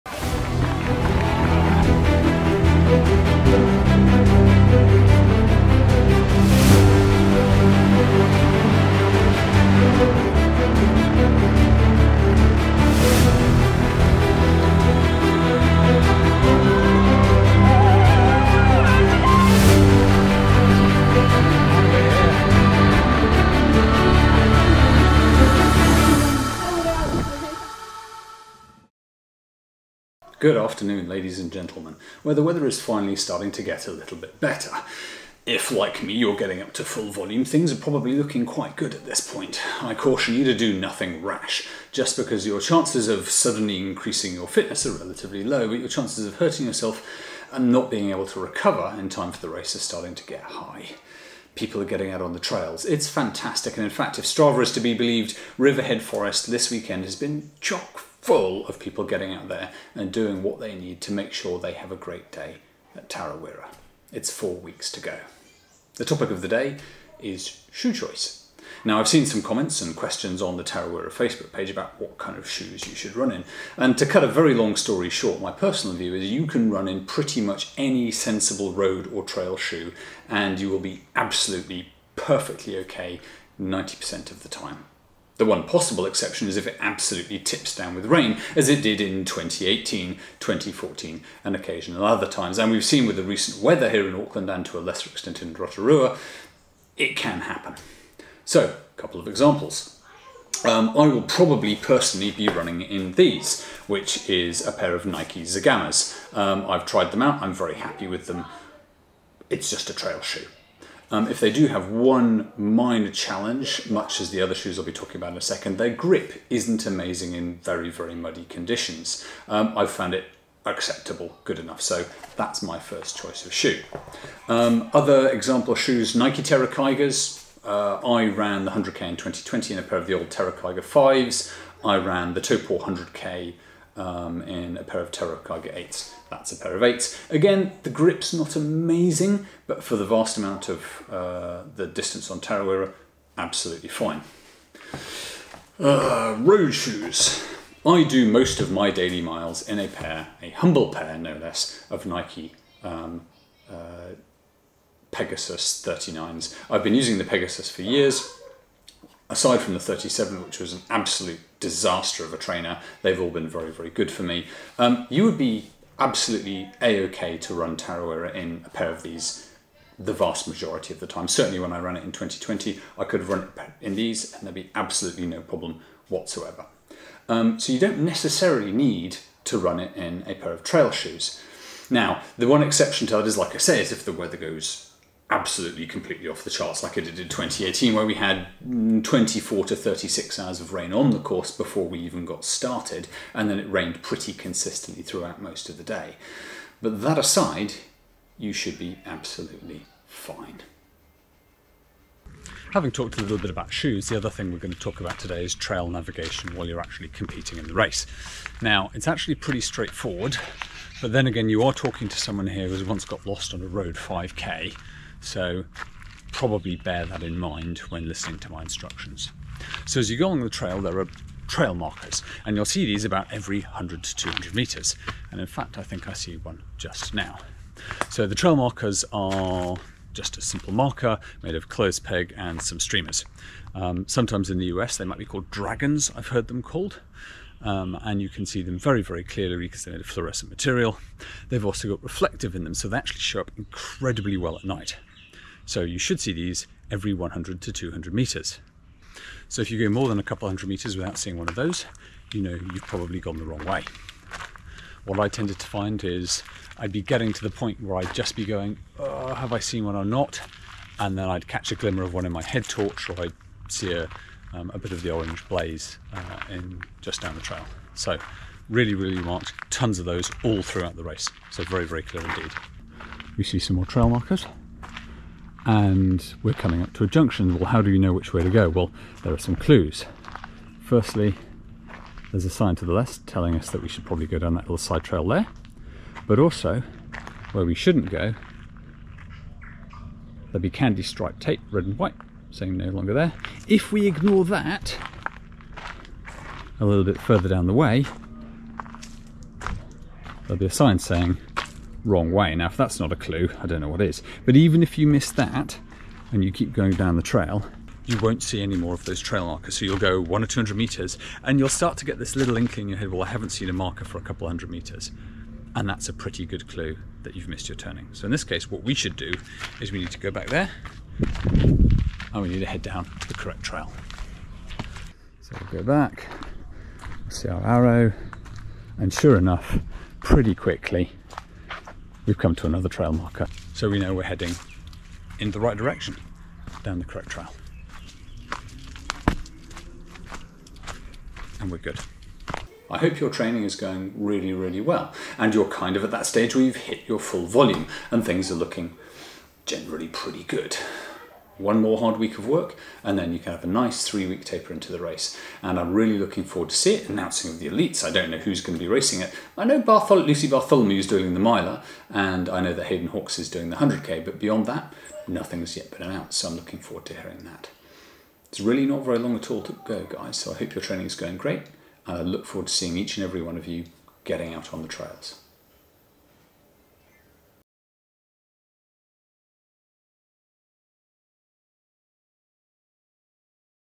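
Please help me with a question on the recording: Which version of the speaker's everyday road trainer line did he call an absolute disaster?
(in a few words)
37.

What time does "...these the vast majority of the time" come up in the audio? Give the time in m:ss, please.
2:49.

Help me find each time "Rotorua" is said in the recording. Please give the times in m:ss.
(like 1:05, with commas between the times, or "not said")
1:35.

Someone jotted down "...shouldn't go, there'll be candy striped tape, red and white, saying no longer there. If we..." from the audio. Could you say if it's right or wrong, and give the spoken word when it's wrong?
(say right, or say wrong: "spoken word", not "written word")
right.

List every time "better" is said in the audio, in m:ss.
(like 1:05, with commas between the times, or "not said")
0:34.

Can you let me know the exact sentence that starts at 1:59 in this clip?
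Um, I've found it acceptable, good enough.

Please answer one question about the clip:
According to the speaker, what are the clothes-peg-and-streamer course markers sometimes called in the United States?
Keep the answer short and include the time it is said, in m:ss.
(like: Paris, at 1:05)
dragons, at 3:55.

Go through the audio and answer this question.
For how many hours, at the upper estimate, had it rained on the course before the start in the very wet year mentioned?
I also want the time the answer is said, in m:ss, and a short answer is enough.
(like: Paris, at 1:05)
36, at 3:09.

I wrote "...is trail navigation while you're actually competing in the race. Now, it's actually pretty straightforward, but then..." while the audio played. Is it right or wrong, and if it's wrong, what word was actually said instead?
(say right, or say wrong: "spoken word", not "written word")
right.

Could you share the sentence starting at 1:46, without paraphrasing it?
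Um, I've tried them out, I'm very happy with them.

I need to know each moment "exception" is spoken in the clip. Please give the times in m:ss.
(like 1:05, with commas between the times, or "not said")
1:26, 3:02.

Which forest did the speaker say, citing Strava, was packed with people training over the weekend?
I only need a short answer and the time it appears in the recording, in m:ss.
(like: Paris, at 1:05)
Riverhead Forest, at 0:55.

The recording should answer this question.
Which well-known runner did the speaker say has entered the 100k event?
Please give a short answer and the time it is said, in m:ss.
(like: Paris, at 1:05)
Hayden Hawks, at 6:02.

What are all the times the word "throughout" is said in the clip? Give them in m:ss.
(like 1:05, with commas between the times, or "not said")
3:15, 4:30.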